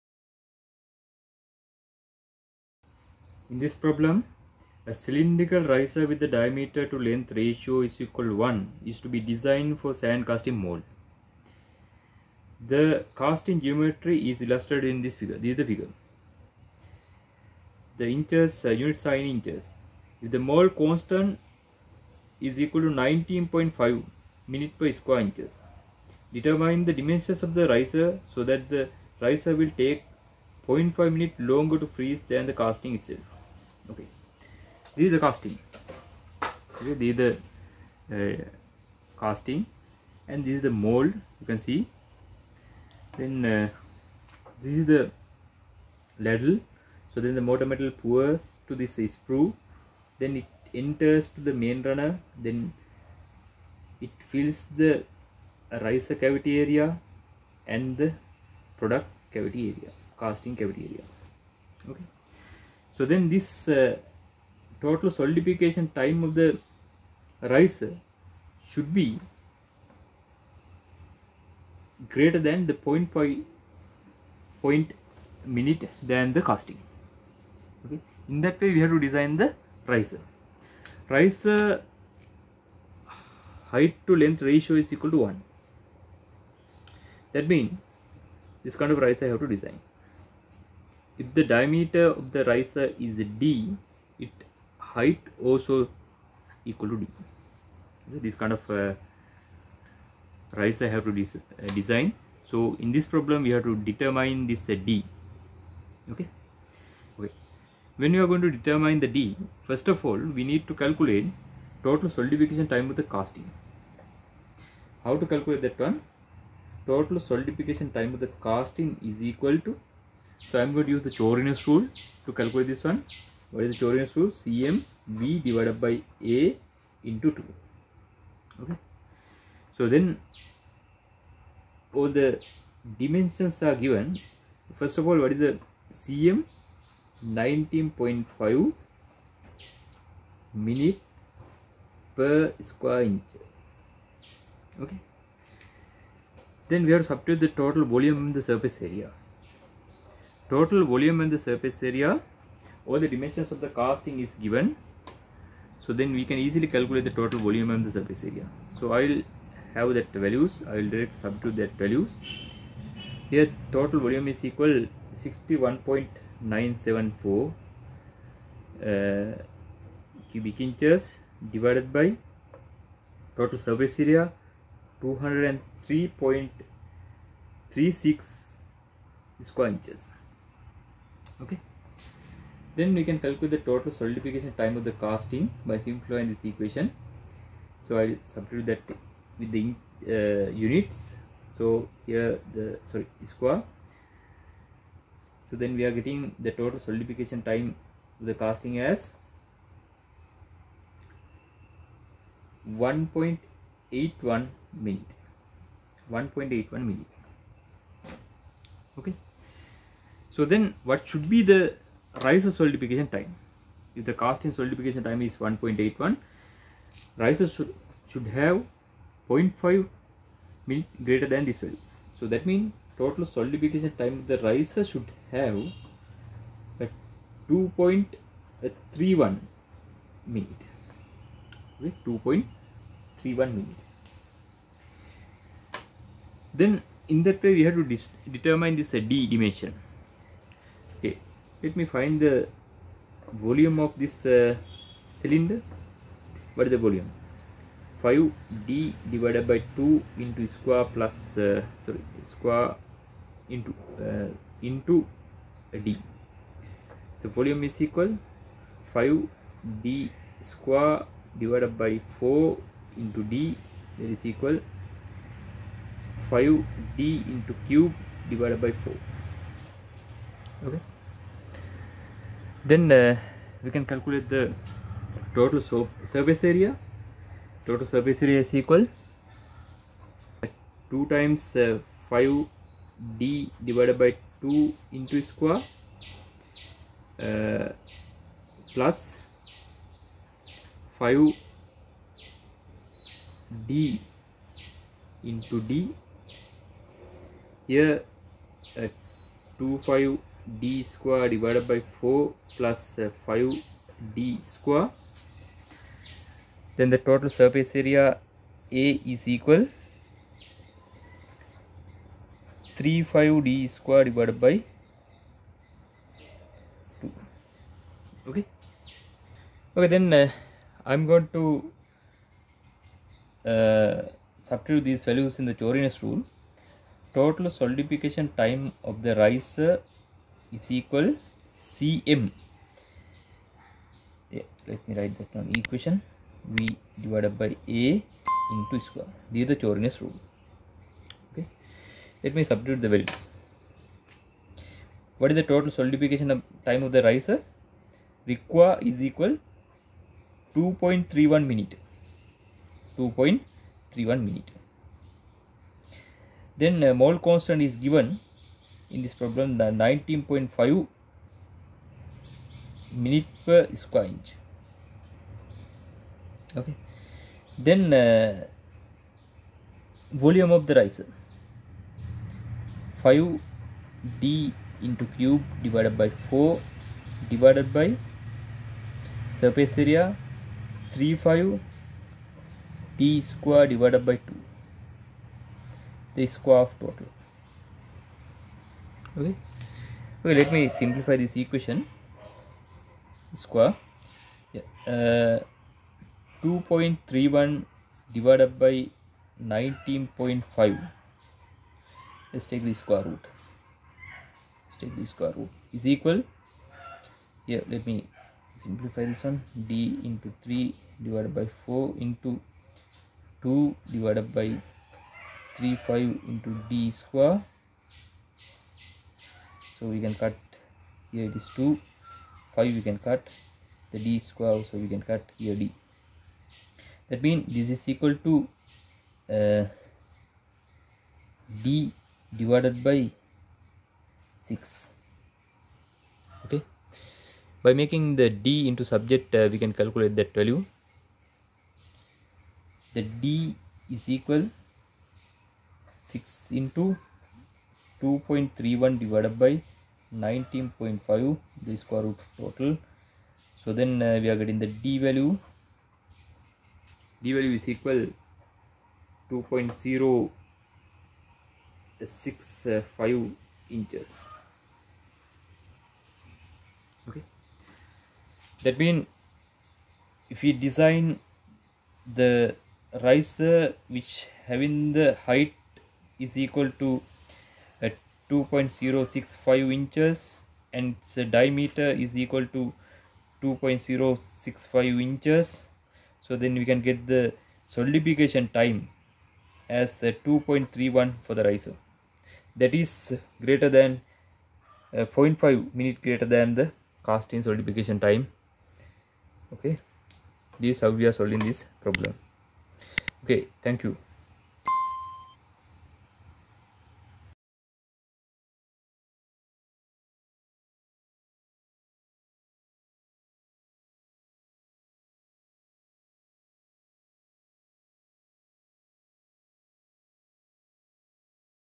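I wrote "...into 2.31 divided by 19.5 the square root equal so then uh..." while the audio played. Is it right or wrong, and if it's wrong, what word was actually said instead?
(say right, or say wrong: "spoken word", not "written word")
wrong: "total", not "equal".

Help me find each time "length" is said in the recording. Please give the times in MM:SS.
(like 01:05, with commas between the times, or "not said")
00:06, 01:24.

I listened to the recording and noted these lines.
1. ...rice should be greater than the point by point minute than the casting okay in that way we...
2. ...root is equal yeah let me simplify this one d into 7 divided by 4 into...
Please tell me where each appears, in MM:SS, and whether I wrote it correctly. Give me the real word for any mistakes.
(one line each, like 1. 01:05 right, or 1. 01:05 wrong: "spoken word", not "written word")
1. 01:07 right
2. 06:45 wrong: "3", not "7".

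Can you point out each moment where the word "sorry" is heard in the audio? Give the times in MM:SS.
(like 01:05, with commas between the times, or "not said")
03:12, 04:11.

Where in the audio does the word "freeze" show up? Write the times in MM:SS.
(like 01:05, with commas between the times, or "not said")
00:31.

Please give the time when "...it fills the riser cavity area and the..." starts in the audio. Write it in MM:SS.
00:54.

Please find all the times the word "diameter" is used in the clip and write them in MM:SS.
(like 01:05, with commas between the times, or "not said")
00:06, 01:31, 08:01.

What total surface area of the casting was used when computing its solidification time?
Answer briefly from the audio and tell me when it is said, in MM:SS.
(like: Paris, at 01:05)
203.36 square inches, at 02:55.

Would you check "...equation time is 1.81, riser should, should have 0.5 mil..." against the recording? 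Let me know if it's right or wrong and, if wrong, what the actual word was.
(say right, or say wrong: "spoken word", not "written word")
wrong: "solidification", not "equation".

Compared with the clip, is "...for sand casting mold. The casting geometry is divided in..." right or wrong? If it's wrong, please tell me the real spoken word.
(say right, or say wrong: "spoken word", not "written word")
wrong: "illustrated", not "divided".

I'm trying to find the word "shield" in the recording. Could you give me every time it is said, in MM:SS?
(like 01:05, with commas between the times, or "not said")
not said.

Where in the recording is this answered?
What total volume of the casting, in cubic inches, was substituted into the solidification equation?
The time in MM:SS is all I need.
02:45.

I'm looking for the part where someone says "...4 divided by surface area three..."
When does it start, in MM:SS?
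06:16.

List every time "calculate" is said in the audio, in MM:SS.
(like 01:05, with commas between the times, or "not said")
01:50, 01:55, 02:02, 02:36, 03:03, 04:33, 07:19.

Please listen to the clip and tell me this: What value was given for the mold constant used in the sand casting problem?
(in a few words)
19.5 minutes per square inch.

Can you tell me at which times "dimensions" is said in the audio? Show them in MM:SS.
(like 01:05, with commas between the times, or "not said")
00:26, 02:12, 02:33, 03:59.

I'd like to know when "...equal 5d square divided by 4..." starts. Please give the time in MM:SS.
04:17.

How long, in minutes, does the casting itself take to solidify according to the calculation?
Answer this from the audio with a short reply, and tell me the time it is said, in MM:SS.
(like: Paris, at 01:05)
1.81 minutes, at 03:22.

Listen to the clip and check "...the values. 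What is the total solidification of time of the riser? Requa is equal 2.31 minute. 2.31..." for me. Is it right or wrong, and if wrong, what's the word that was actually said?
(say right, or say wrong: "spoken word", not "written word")
right.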